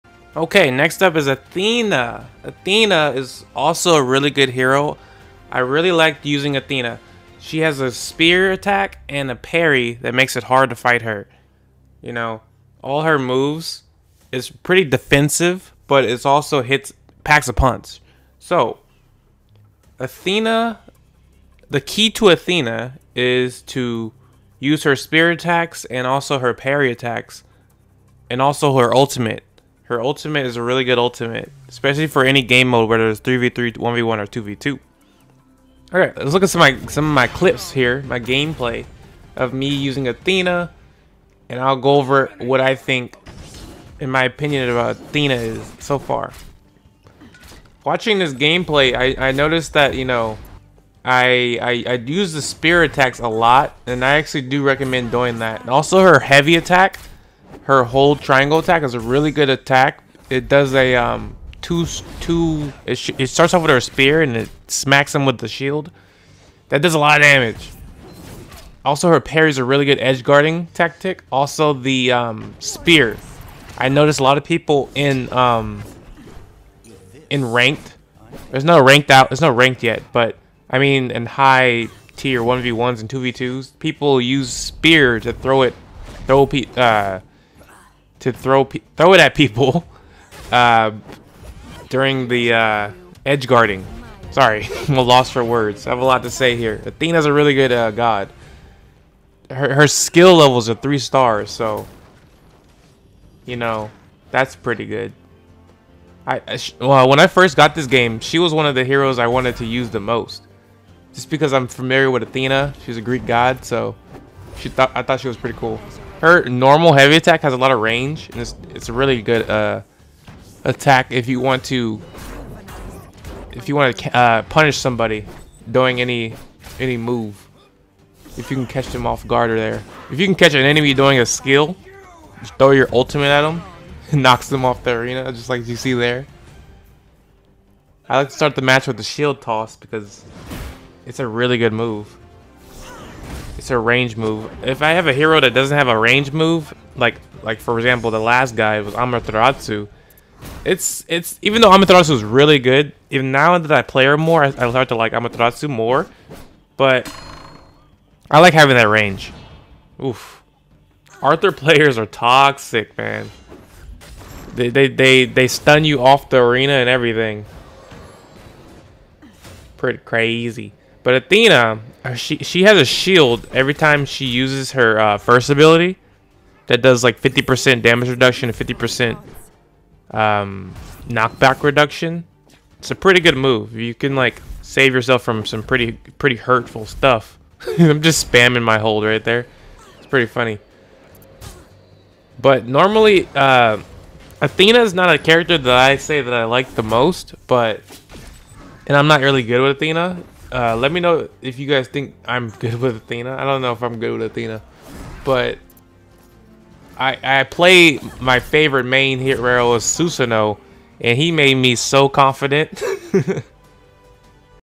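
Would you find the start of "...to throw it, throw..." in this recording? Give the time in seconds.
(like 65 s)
85 s.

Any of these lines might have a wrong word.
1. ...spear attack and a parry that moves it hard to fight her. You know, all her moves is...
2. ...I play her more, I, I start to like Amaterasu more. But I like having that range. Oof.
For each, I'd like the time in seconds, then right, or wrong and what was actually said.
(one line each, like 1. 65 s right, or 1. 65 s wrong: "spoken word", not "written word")
1. 7 s wrong: "makes", not "moves"
2. 153 s right.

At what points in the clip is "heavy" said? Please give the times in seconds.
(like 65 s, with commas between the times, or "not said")
56 s, 116 s.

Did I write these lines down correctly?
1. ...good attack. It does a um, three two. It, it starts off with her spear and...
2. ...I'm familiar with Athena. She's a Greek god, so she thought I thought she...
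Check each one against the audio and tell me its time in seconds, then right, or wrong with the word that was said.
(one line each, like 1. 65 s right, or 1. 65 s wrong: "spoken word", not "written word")
1. 59 s wrong: "two", not "three"
2. 111 s right.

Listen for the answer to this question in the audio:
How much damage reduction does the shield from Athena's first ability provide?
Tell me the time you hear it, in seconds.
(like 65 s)
177 s.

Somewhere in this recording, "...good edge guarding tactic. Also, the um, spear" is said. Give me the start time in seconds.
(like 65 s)
69 s.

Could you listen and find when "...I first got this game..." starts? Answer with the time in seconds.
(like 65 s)
107 s.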